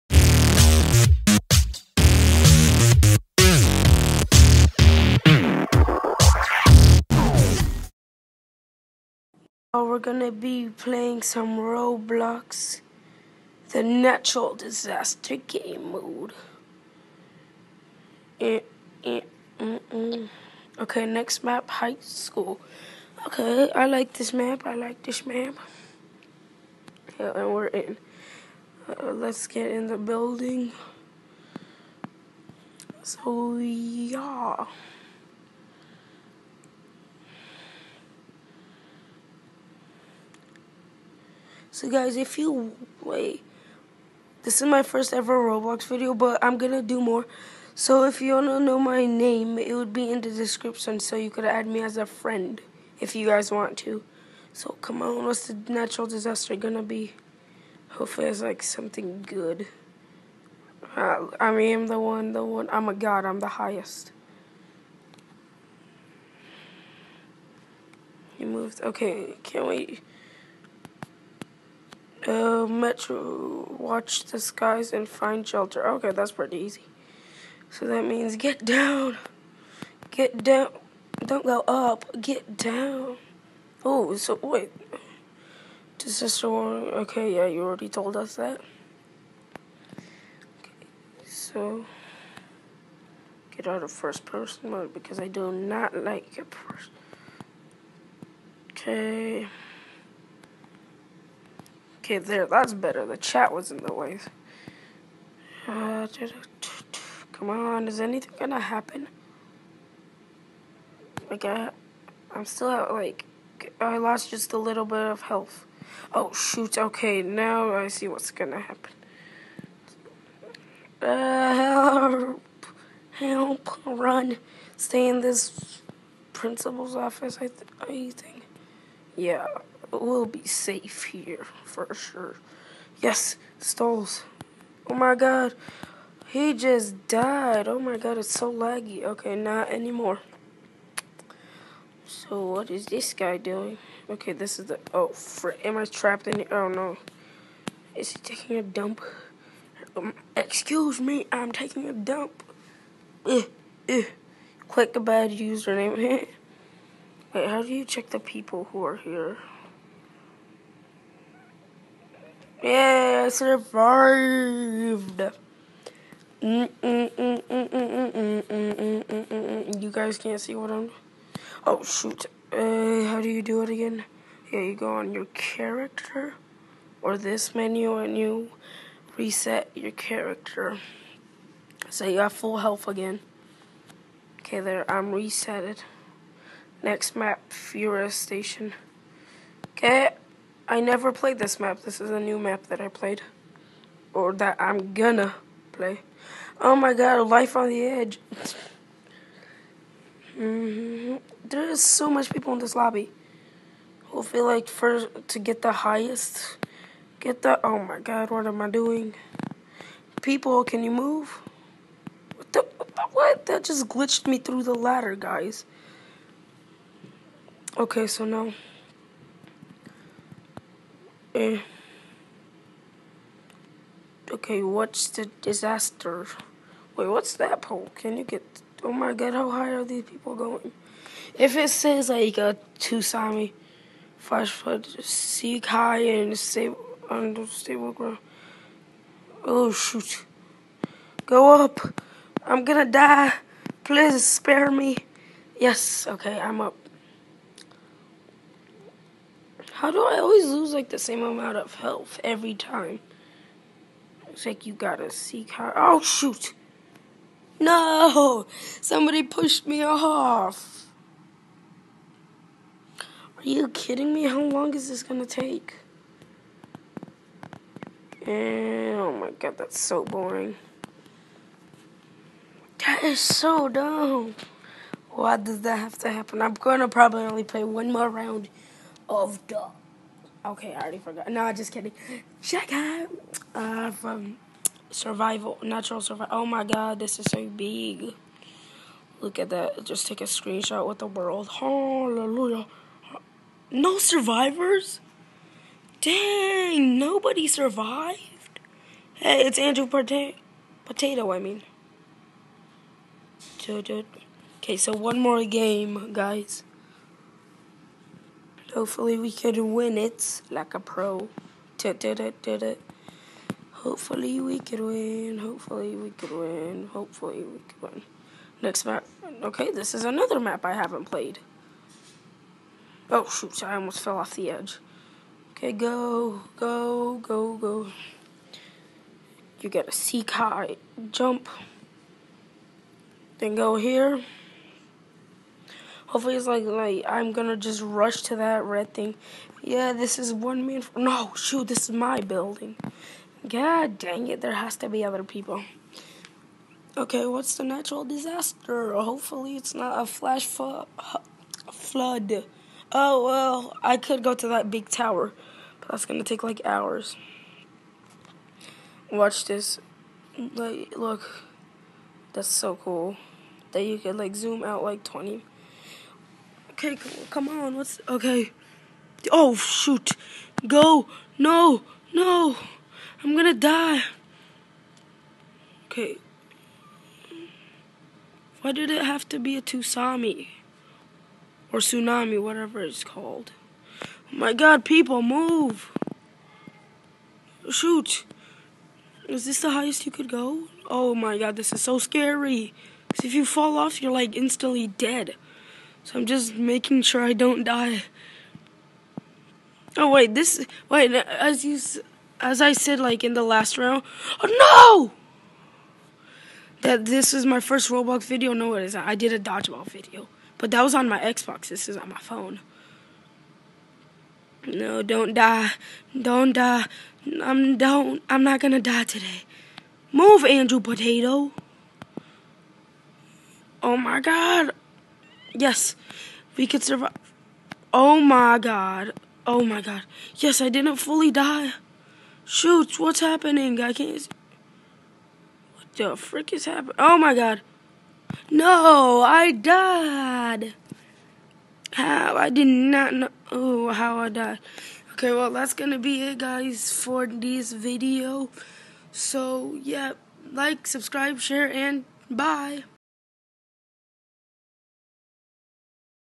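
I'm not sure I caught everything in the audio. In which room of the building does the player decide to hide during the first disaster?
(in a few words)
Principal's office.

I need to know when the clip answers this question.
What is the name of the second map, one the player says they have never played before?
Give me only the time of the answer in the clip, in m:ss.
3:07.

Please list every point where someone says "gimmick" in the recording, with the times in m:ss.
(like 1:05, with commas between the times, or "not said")
not said.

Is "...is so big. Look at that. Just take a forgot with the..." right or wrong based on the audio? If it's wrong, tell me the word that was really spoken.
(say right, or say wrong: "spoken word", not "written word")
wrong: "screenshot", not "forgot".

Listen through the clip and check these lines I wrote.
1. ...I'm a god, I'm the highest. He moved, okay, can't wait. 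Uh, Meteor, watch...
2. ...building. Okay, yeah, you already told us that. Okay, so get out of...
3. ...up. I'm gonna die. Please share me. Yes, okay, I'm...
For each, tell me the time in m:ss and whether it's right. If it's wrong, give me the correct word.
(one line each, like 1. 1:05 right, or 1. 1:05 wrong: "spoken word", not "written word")
1. 1:02 right
2. 1:26 wrong: "warning", not "building"
3. 4:01 wrong: "spare", not "share".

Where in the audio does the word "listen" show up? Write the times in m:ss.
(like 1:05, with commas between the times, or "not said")
not said.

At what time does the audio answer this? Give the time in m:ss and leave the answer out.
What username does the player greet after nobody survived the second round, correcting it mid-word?
4:59.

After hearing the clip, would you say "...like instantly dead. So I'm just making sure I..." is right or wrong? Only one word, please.
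right.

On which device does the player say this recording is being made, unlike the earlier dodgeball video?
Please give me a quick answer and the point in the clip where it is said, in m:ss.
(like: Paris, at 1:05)
Phone, at 6:52.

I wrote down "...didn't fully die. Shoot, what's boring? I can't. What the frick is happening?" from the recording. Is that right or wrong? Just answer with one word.
wrong.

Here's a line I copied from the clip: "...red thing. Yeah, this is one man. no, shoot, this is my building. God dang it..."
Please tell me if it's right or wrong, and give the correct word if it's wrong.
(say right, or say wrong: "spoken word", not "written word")
right.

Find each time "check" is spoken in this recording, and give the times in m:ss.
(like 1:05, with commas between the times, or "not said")
2:37, 4:42.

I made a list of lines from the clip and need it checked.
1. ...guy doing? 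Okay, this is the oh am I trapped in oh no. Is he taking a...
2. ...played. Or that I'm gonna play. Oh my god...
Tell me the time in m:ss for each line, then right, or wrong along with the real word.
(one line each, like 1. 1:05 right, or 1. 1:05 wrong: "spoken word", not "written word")
1. 2:23 right
2. 3:12 right.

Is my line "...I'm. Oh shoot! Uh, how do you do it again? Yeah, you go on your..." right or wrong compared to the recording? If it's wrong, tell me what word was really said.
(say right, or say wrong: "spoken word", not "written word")
right.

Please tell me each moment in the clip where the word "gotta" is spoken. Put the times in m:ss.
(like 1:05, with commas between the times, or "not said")
4:14, 5:29.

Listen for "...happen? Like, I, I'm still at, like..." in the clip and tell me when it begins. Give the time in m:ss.
1:48.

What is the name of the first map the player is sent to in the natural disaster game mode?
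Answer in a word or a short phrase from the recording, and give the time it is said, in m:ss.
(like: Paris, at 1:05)
High school, at 0:21.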